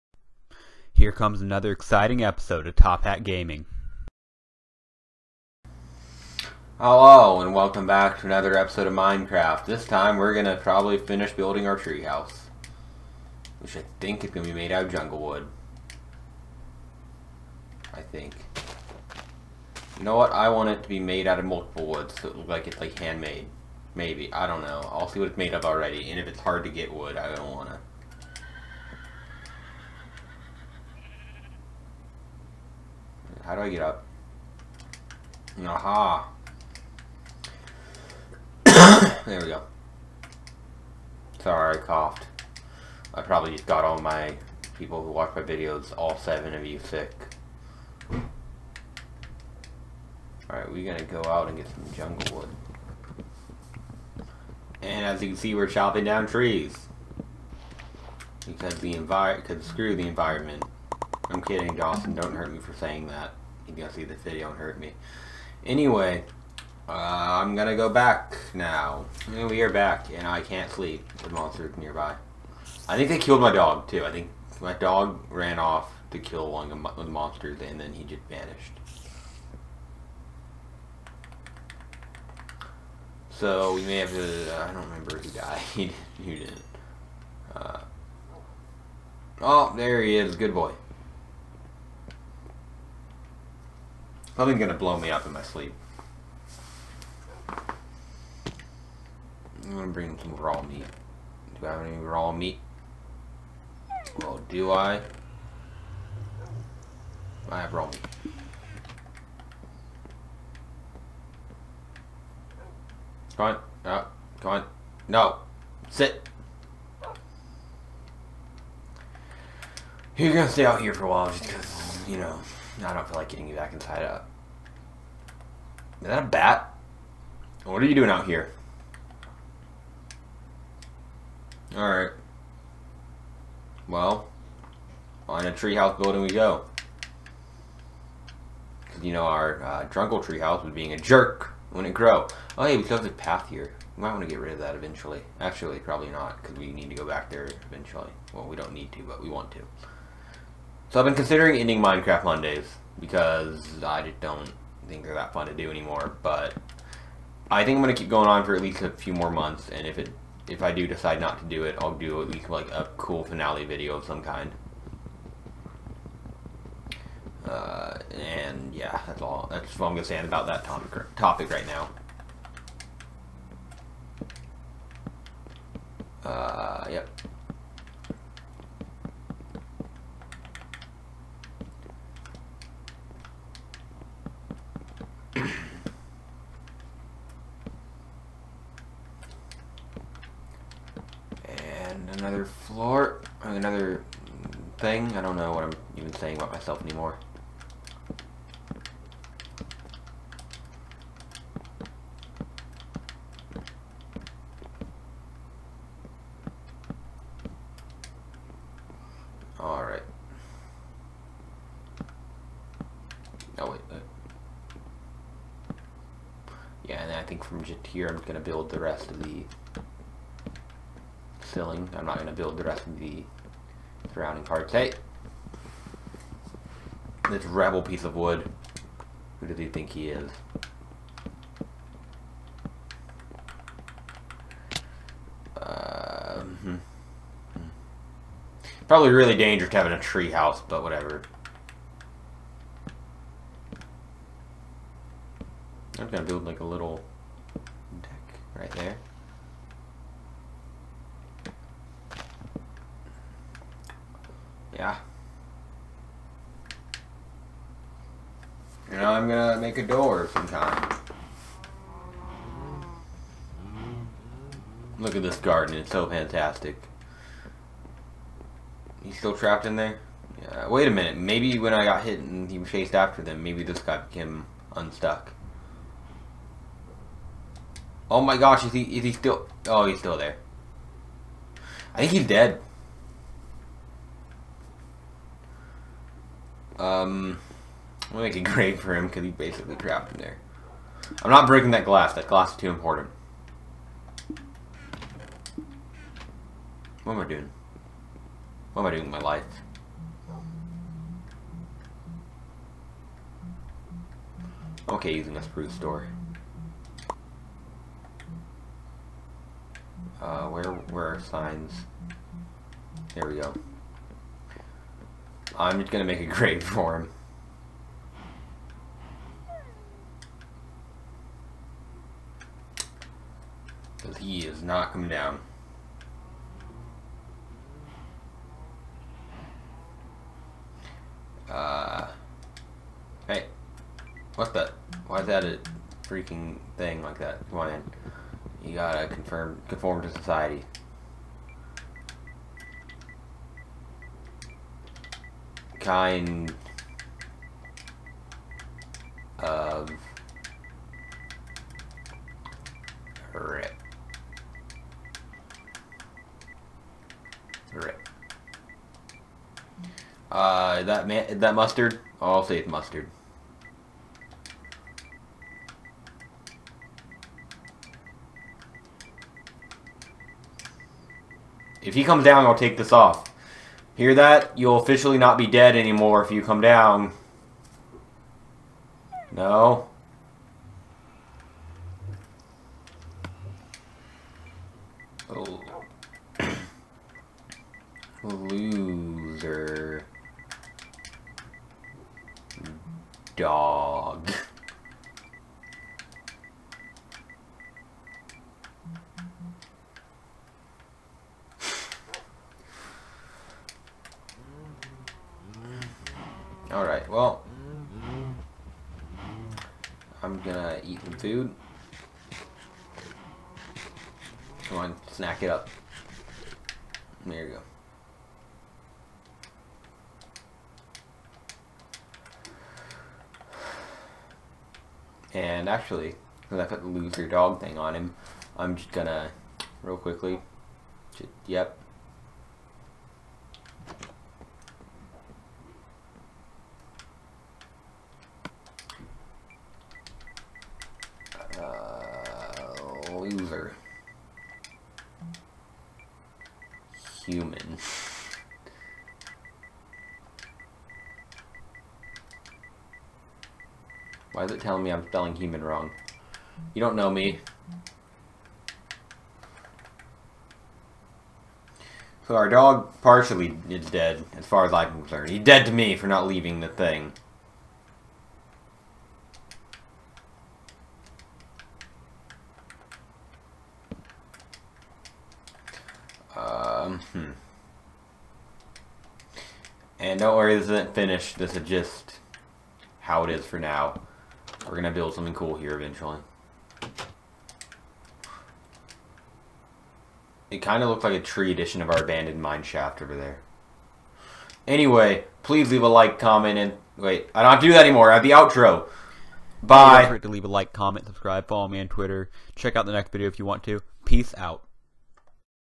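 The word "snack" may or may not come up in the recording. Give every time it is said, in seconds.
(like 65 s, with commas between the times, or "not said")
415 s.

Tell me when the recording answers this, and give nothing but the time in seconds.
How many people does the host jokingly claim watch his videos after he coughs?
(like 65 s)
46 s.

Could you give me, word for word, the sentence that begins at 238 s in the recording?
Probably really dangerous having a tree house, but whatever.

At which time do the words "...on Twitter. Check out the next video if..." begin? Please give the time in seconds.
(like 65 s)
501 s.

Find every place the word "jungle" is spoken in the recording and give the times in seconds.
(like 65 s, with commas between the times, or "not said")
14 s, 51 s.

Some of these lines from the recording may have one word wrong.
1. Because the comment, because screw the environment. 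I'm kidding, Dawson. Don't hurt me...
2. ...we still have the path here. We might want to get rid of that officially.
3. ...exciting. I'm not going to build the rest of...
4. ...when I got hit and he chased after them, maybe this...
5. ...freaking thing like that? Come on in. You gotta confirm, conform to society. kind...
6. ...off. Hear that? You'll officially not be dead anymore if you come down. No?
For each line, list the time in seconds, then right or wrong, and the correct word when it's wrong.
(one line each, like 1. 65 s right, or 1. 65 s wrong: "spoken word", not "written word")
1. 58 s wrong: "environment", not "comment"
2. 142 s wrong: "eventually", not "officially"
3. 221 s wrong: "filling", not "exciting"
4. 271 s right
5. 336 s right
6. 372 s right.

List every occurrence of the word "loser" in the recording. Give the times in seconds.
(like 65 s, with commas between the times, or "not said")
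426 s, 443 s.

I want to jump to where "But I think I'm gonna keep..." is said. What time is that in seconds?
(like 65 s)
156 s.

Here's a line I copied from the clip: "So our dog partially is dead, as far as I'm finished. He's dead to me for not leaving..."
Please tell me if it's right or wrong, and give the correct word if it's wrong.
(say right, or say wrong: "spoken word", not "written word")
wrong: "concerned", not "finished".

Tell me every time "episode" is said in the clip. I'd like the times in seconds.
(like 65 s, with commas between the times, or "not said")
2 s, 8 s.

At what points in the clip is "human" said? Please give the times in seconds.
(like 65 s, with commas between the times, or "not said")
447 s, 455 s.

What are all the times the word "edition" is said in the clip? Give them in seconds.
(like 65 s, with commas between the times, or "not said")
491 s.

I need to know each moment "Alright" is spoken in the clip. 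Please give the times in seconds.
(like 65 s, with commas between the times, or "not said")
50 s, 131 s, 209 s.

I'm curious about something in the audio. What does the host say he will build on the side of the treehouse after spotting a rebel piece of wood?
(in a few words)
a little deck.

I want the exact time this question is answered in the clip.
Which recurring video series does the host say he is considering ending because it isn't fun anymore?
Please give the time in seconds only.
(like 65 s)
151 s.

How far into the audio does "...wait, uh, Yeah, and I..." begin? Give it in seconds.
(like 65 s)
213 s.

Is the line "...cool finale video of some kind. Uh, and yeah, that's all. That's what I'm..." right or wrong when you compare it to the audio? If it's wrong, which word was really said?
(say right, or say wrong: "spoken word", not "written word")
right.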